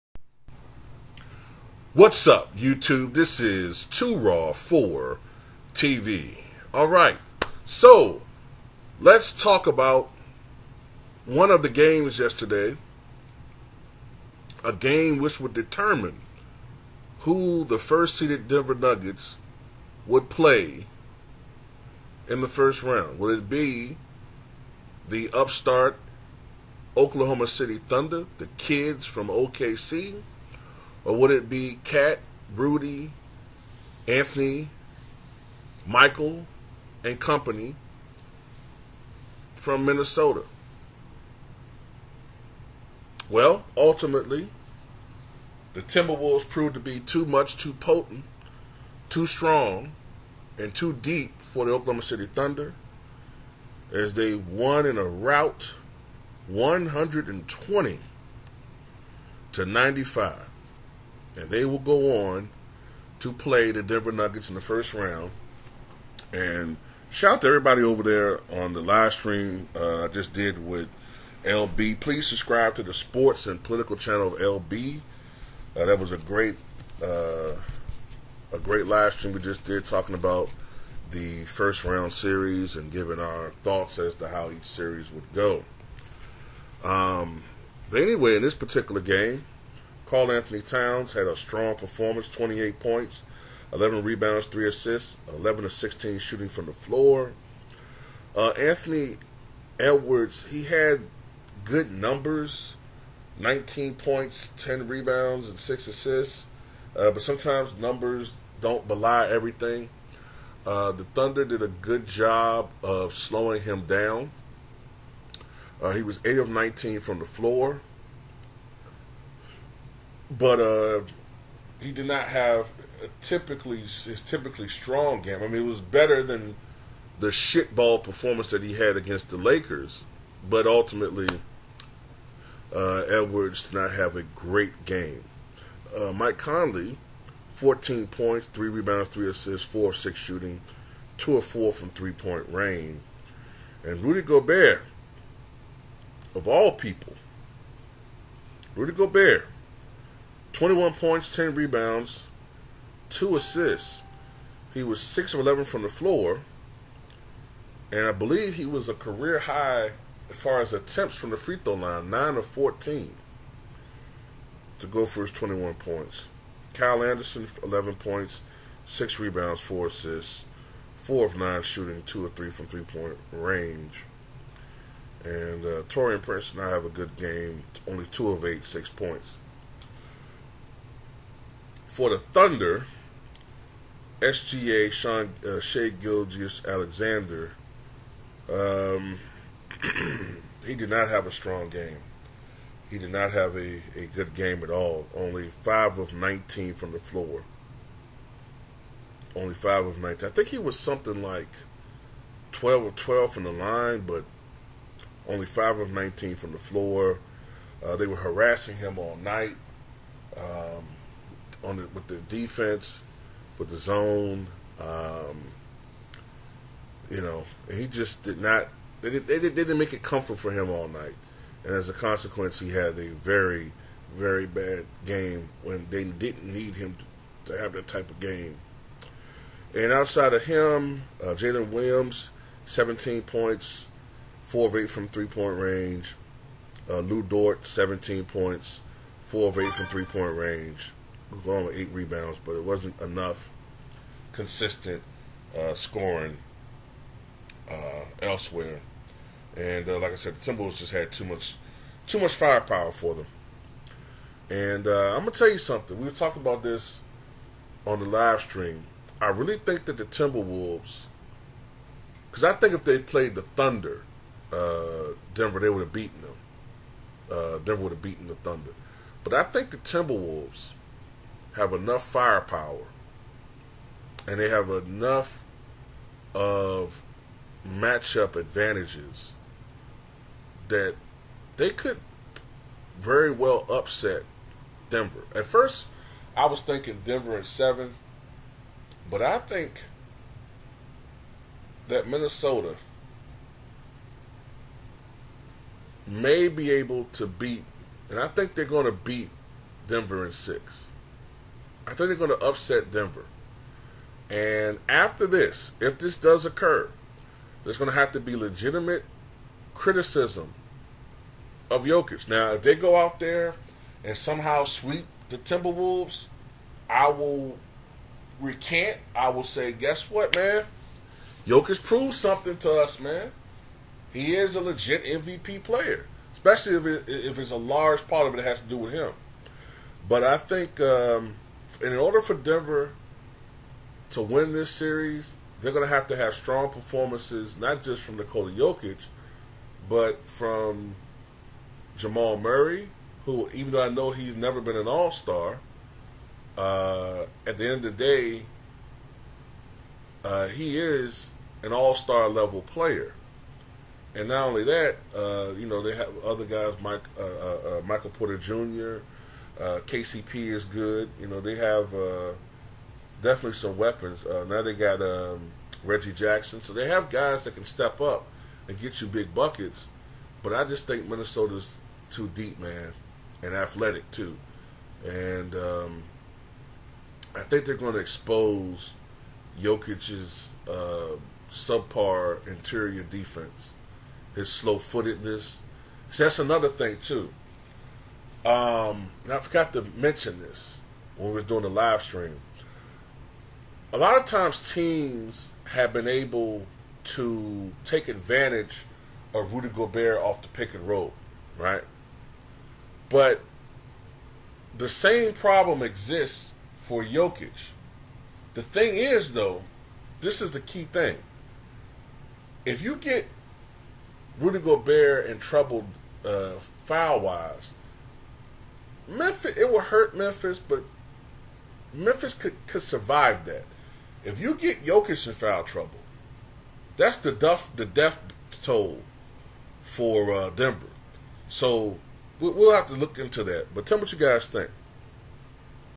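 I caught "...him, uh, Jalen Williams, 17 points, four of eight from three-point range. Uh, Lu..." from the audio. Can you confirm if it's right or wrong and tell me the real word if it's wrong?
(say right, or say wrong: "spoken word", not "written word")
right.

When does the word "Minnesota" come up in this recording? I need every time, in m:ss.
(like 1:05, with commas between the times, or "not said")
0:39, 4:52, 6:11.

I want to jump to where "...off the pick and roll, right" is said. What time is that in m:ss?
6:40.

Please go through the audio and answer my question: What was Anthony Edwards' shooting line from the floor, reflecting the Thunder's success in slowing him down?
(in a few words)
8 of 19.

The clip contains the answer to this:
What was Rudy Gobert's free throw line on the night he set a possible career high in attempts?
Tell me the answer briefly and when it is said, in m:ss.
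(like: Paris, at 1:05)
9 of 14, at 2:42.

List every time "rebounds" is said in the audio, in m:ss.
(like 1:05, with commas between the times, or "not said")
1:34, 1:44, 2:18, 2:31, 2:49, 4:01.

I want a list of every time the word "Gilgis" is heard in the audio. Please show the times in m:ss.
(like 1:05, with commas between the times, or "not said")
3:05.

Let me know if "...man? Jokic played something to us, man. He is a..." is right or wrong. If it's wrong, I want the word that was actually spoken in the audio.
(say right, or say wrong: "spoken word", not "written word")
wrong: "proved", not "played".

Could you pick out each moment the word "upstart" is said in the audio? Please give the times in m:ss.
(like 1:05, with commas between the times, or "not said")
0:25.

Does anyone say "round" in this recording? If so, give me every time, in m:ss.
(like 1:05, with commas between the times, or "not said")
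0:22, 1:04, 1:21.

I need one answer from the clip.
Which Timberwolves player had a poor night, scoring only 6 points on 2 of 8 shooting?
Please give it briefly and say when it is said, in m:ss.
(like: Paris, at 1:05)
Taurean Prince, at 2:55.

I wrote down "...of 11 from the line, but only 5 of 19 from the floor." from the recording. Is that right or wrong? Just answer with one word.
wrong.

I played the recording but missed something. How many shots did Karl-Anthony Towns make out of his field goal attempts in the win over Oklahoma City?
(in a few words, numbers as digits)
11 of 16.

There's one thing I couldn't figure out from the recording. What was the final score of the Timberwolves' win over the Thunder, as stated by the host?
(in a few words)
120 to 95.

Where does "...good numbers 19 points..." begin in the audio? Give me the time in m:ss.
1:41.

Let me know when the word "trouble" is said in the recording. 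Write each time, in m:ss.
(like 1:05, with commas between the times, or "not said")
6:55, 7:05.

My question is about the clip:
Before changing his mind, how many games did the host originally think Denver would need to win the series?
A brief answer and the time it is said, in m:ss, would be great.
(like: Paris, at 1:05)
7, at 4:47.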